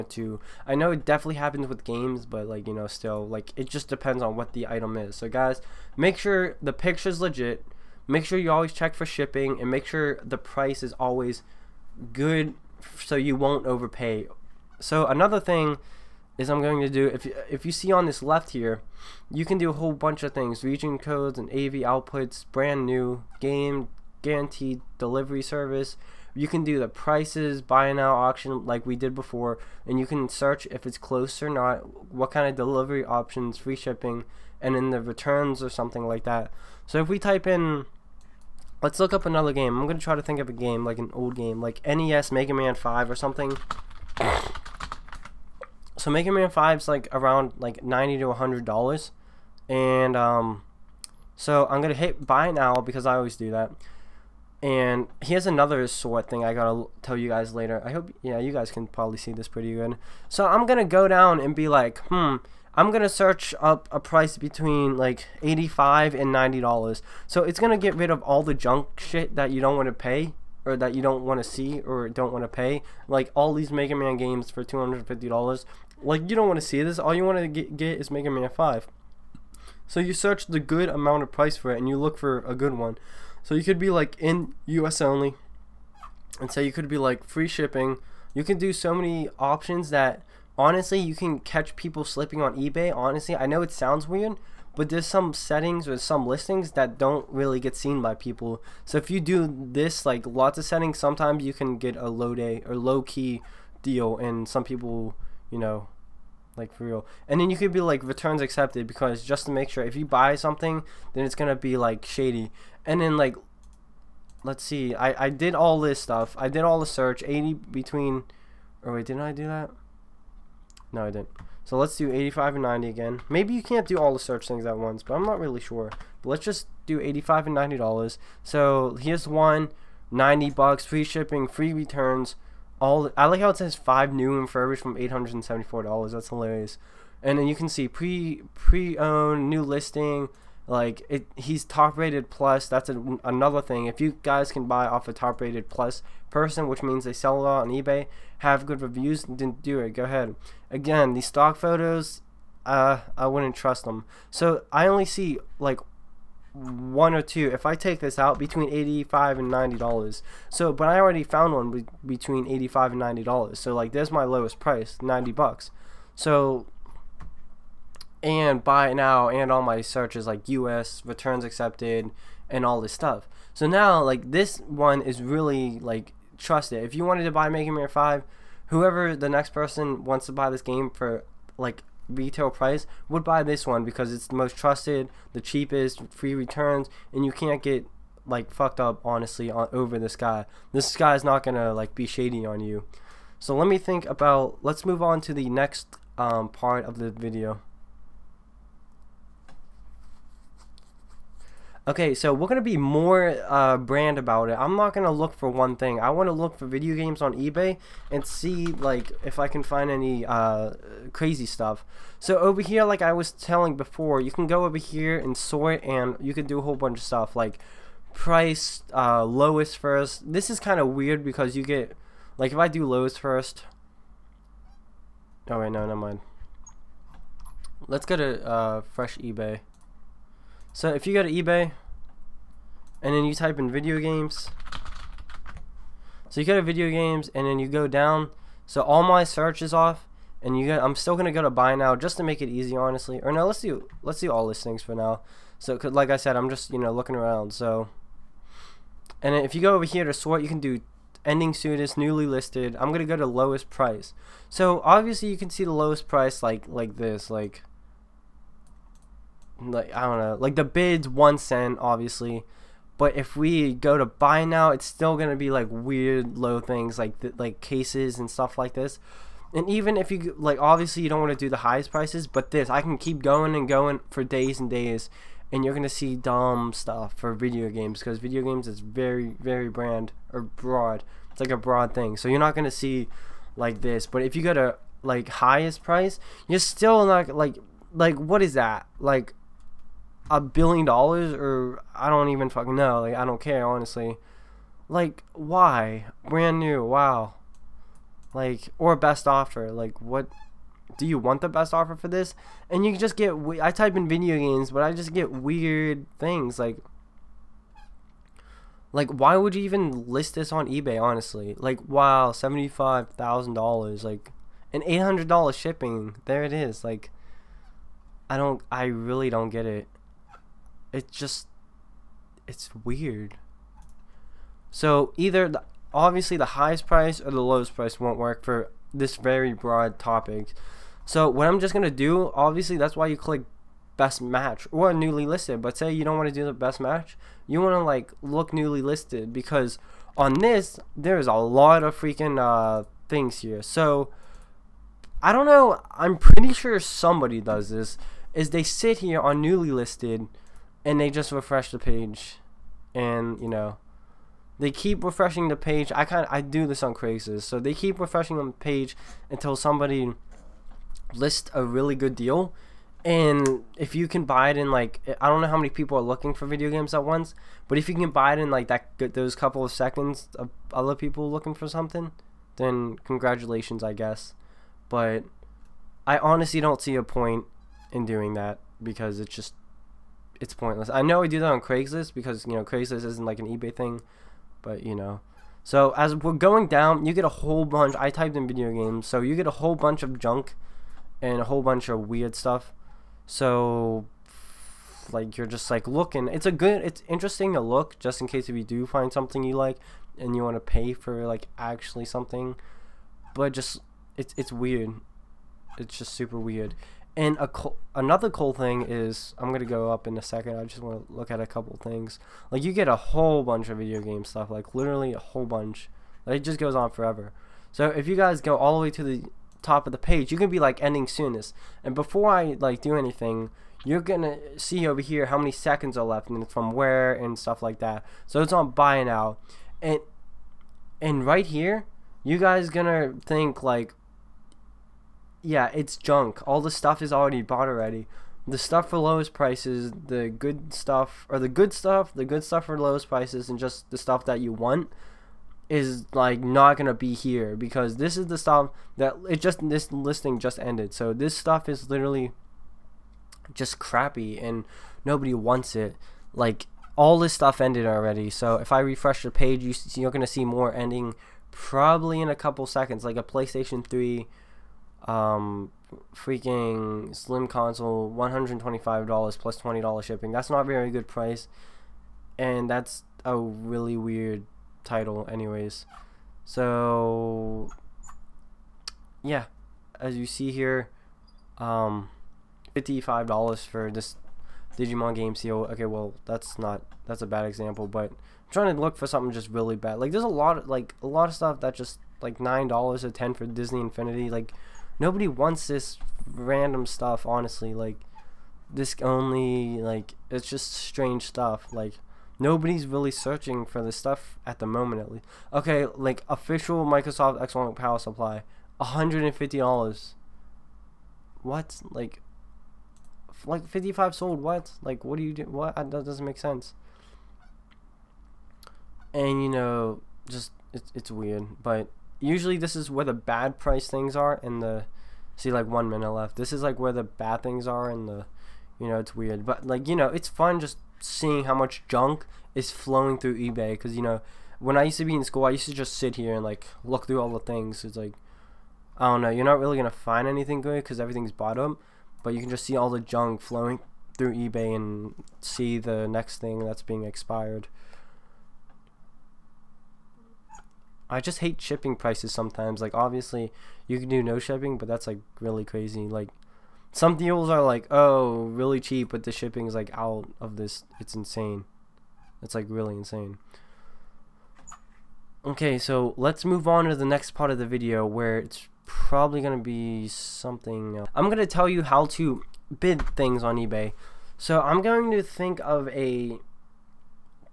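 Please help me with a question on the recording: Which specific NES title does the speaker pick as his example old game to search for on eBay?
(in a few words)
Mega Man 5.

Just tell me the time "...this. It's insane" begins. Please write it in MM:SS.
09:20.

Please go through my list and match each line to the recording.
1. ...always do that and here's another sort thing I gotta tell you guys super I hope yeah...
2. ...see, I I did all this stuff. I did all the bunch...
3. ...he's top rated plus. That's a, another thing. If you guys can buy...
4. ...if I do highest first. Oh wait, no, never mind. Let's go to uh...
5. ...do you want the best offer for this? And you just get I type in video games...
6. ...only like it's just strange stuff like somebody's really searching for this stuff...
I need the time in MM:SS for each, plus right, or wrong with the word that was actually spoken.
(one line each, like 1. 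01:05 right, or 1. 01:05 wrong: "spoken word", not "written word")
1. 00:53 wrong: "later", not "super"
2. 01:54 wrong: "search", not "bunch"
3. 02:21 right
4. 03:42 wrong: "lowest", not "highest"
5. 05:00 right
6. 08:19 wrong: "nobody", not "somebody".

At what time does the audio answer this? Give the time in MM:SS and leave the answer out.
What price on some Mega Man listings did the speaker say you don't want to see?
01:14.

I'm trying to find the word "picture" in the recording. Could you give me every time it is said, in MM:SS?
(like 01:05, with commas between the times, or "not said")
00:06.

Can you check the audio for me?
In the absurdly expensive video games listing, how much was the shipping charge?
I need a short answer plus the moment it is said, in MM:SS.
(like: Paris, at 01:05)
$800, at 05:14.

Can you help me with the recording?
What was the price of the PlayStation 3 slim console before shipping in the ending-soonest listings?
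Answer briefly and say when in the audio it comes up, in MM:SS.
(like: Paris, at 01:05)
$125, at 07:48.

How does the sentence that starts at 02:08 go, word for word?
So here's one, 90 bucks, free shipping, free returns.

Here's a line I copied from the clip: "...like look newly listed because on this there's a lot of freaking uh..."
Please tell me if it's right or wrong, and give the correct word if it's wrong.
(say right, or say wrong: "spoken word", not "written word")
right.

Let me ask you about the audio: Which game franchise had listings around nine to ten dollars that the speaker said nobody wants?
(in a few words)
Disney Infinity.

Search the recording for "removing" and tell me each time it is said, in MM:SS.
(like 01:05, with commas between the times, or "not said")
not said.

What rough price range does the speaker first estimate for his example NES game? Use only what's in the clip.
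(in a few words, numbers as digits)
90 to 100 dollars.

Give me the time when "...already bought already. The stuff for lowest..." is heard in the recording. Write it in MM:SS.
07:17.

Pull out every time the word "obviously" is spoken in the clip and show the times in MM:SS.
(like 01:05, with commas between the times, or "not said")
04:14, 04:21, 04:30, 05:25, 05:32, 09:12.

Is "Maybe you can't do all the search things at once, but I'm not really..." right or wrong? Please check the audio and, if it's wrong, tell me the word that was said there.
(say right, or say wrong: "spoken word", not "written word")
right.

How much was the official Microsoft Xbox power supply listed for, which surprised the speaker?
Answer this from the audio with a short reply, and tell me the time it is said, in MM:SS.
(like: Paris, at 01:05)
$150, at 08:28.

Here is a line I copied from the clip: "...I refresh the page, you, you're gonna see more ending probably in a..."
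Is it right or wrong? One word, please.
right.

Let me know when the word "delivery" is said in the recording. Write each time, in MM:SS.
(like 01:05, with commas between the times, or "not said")
00:24, 00:32.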